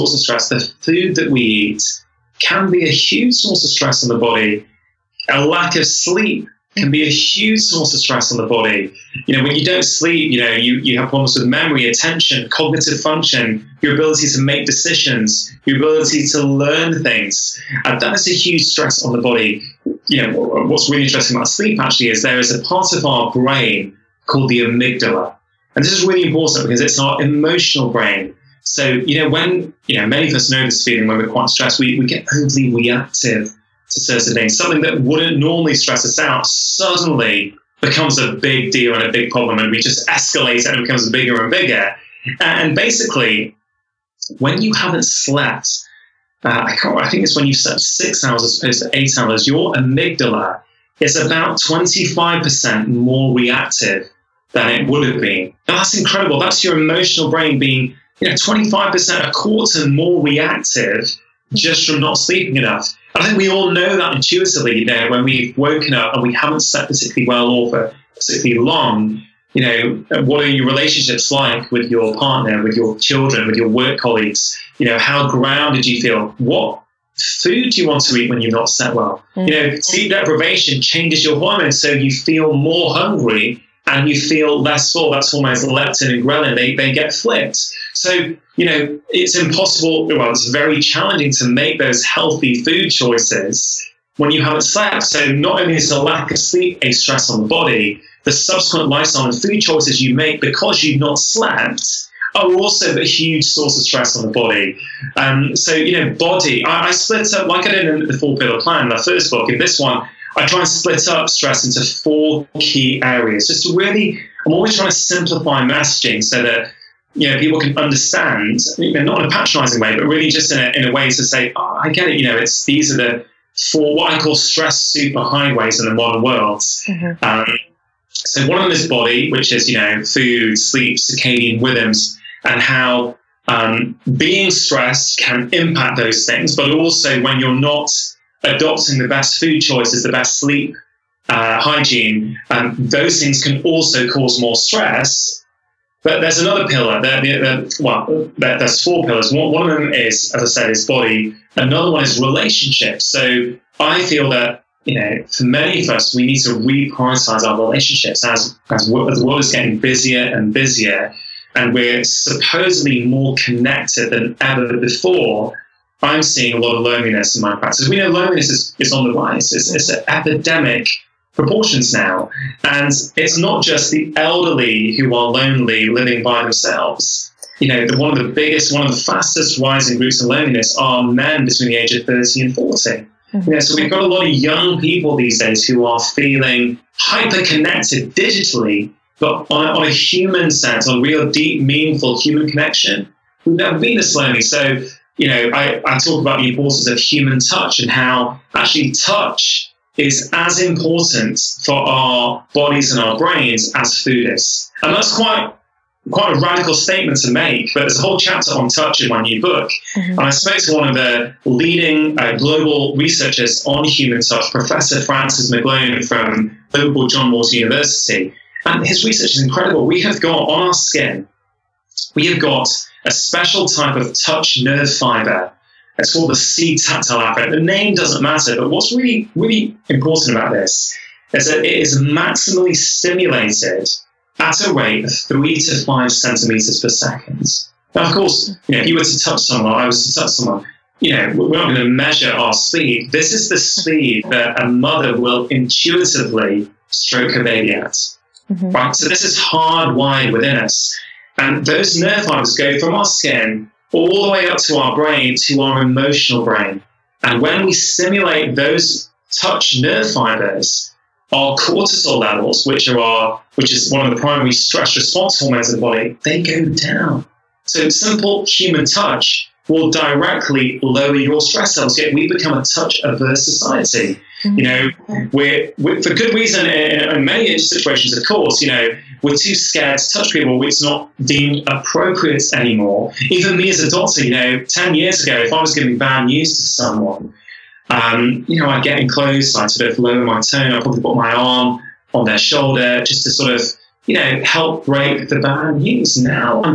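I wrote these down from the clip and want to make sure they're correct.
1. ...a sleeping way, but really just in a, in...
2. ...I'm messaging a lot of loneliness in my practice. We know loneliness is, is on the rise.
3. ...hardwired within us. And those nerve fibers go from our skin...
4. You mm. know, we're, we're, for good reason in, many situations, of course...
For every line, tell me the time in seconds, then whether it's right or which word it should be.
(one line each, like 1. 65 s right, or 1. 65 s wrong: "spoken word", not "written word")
1. 119 s wrong: "patronizing", not "sleeping"
2. 166 s wrong: "seeing", not "messaging"
3. 249 s right
4. 274 s right.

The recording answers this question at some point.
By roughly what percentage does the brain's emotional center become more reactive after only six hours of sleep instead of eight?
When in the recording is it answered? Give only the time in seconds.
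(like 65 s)
51 s.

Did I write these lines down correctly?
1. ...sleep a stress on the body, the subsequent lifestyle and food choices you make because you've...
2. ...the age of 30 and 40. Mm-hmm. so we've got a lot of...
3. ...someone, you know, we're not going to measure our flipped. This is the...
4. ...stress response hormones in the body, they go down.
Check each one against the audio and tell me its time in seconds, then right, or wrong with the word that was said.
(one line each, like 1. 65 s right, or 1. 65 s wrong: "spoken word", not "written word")
1. 96 s right
2. 181 s right
3. 240 s wrong: "speed", not "flipped"
4. 264 s right.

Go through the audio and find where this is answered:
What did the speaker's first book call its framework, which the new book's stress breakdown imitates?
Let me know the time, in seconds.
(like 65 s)
108 s.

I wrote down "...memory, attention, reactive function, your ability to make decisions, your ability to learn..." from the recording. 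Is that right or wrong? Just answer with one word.
wrong.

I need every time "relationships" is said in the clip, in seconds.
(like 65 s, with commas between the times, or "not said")
70 s, 152 s, 157 s.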